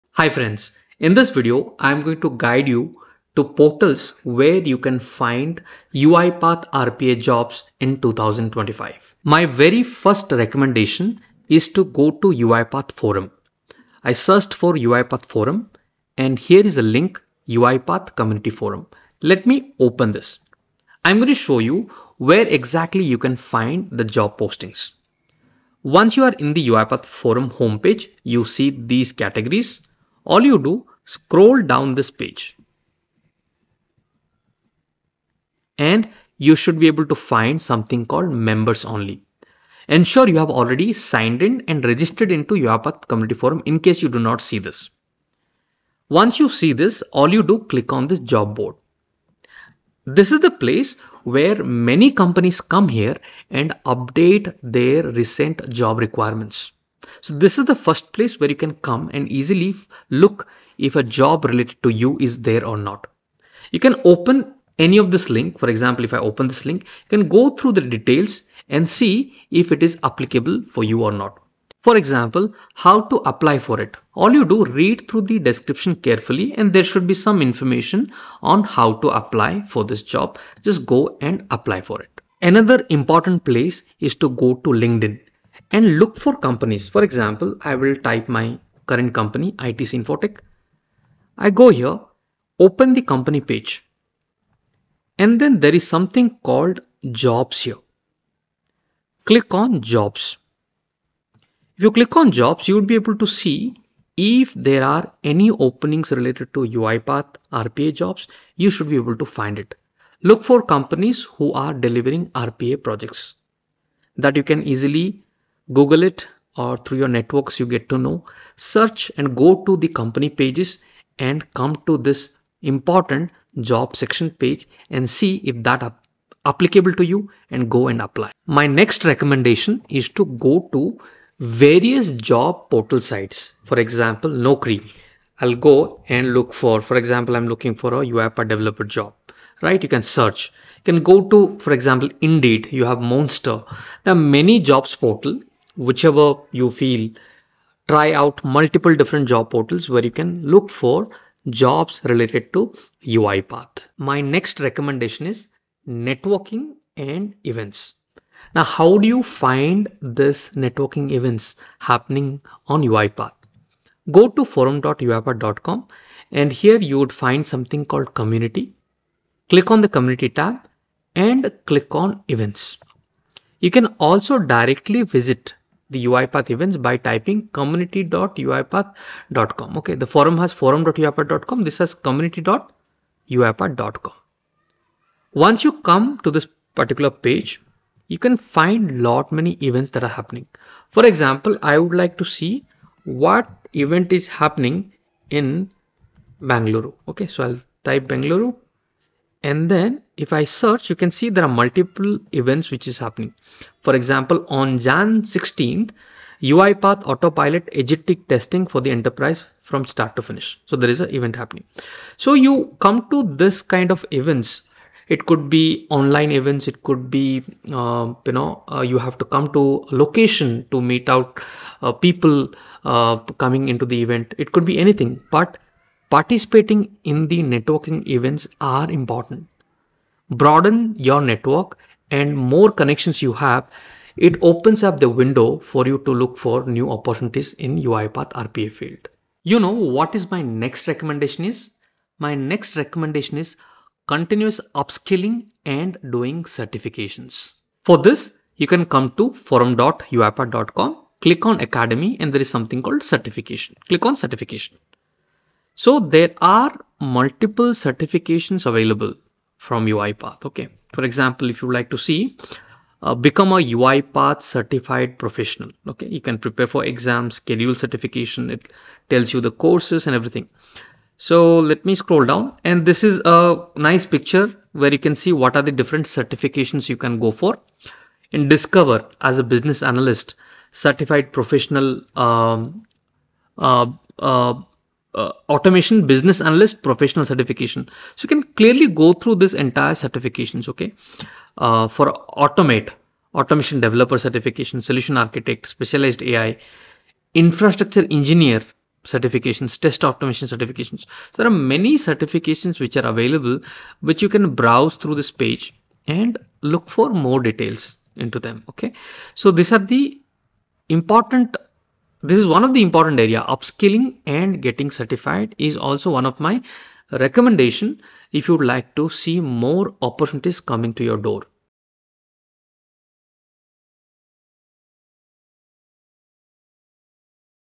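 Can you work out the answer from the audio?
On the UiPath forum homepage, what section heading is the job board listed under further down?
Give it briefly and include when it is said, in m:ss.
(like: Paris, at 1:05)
members only, at 0:38.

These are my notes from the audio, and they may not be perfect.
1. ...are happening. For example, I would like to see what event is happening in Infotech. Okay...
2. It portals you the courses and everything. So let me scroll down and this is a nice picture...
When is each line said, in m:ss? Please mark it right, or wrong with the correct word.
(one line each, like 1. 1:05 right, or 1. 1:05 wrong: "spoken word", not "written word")
1. 3:10 wrong: "Bangalore", not "Infotech"
2. 4:28 wrong: "tells", not "portals".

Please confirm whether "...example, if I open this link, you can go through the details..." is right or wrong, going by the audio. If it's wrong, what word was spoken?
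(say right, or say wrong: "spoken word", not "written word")
right.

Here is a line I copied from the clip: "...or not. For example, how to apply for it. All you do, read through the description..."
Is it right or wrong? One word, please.
right.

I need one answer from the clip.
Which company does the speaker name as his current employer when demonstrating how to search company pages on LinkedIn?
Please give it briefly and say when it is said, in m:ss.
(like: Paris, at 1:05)
ITC Infotech, at 1:29.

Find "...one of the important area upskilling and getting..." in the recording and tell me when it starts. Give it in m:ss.
5:12.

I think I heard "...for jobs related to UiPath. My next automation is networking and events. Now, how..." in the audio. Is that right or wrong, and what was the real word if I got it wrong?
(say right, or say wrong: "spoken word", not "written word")
wrong: "recommendation", not "automation".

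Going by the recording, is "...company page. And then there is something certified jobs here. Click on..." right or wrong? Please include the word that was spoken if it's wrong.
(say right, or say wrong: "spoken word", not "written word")
wrong: "called", not "certified".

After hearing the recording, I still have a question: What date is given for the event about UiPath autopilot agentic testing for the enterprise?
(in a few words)
Jan 16th.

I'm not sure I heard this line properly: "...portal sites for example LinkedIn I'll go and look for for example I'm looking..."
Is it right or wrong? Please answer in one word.
wrong.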